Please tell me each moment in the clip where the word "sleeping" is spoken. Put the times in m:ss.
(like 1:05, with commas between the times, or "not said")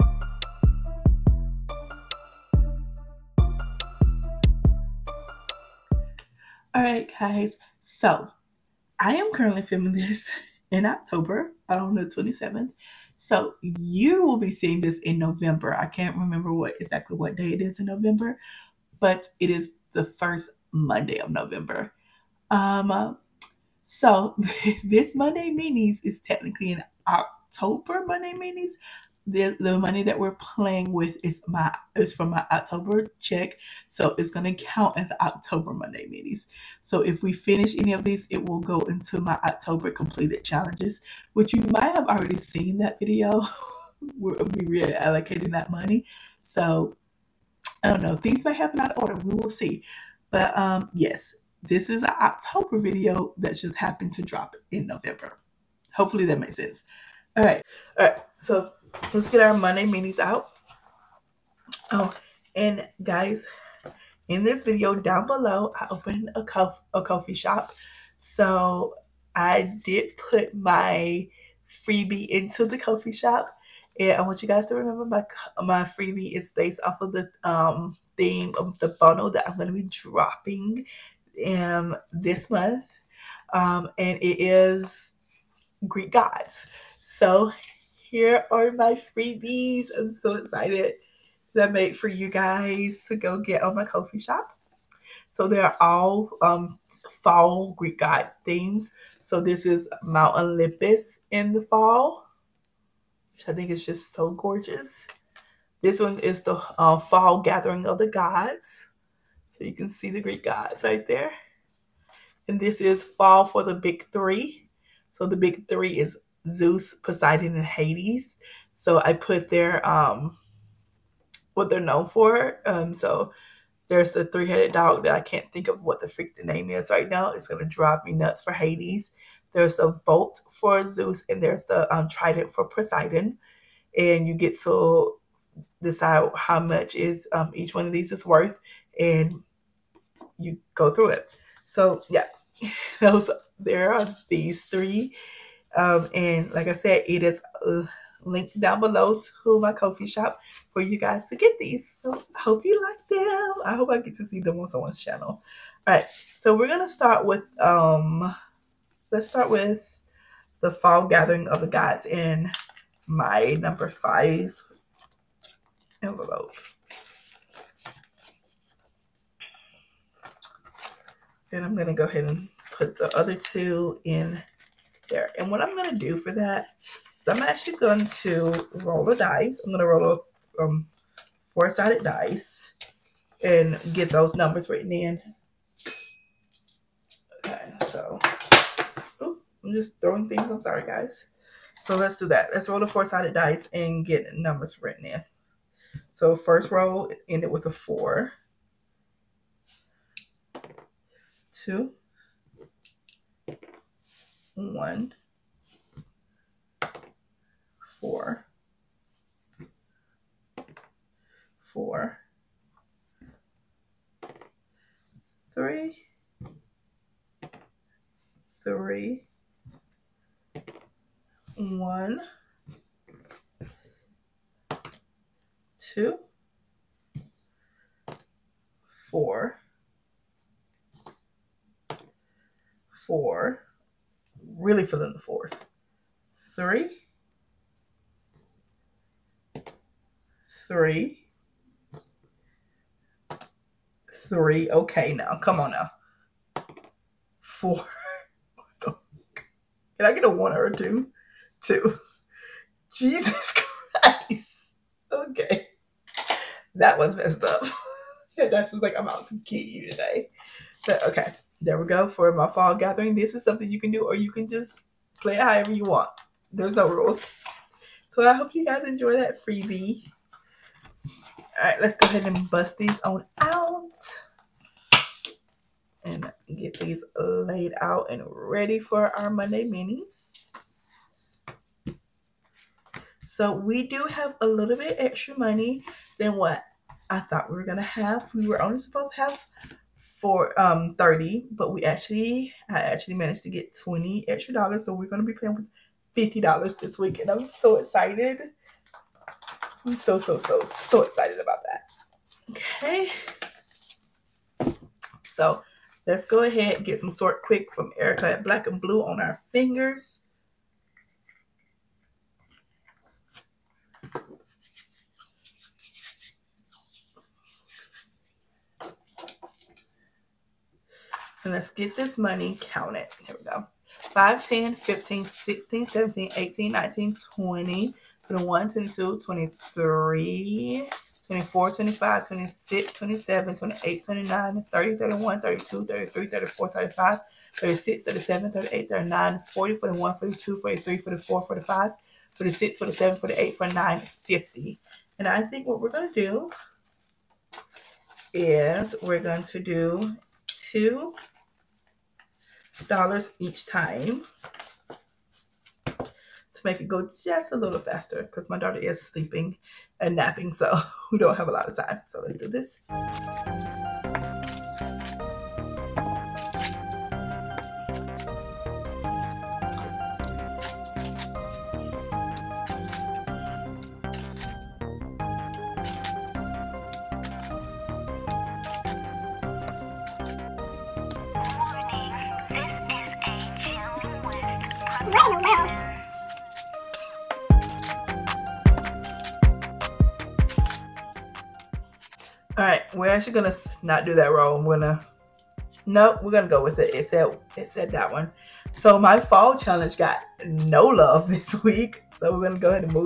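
5:59.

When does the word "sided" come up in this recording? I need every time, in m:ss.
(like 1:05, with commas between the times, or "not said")
3:01, 3:12.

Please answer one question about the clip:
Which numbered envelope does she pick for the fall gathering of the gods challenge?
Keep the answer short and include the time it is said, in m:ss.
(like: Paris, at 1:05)
5, at 2:43.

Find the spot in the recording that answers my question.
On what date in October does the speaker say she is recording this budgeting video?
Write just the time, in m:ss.
0:11.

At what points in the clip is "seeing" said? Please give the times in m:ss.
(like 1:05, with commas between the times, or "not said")
0:14.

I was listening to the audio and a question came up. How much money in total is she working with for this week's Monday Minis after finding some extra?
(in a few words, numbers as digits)
$50.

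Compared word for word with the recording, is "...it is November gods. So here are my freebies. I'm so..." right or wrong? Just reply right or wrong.
wrong.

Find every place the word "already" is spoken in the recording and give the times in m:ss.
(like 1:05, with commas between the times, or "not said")
0:42.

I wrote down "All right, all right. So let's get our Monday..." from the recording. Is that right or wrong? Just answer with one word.
right.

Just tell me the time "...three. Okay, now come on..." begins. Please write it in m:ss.
4:04.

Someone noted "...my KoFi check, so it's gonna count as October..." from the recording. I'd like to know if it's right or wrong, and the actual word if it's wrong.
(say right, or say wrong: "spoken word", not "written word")
wrong: "October", not "KoFi".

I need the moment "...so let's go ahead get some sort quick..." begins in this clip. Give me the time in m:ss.
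5:05.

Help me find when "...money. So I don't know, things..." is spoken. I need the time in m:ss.
0:45.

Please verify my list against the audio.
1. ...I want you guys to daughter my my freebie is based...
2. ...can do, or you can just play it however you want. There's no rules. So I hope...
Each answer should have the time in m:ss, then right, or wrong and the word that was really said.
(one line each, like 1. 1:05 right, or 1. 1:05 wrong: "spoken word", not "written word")
1. 1:14 wrong: "remember", not "daughter"
2. 4:23 right.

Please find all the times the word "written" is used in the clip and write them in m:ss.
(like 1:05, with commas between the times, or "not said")
3:04, 3:14.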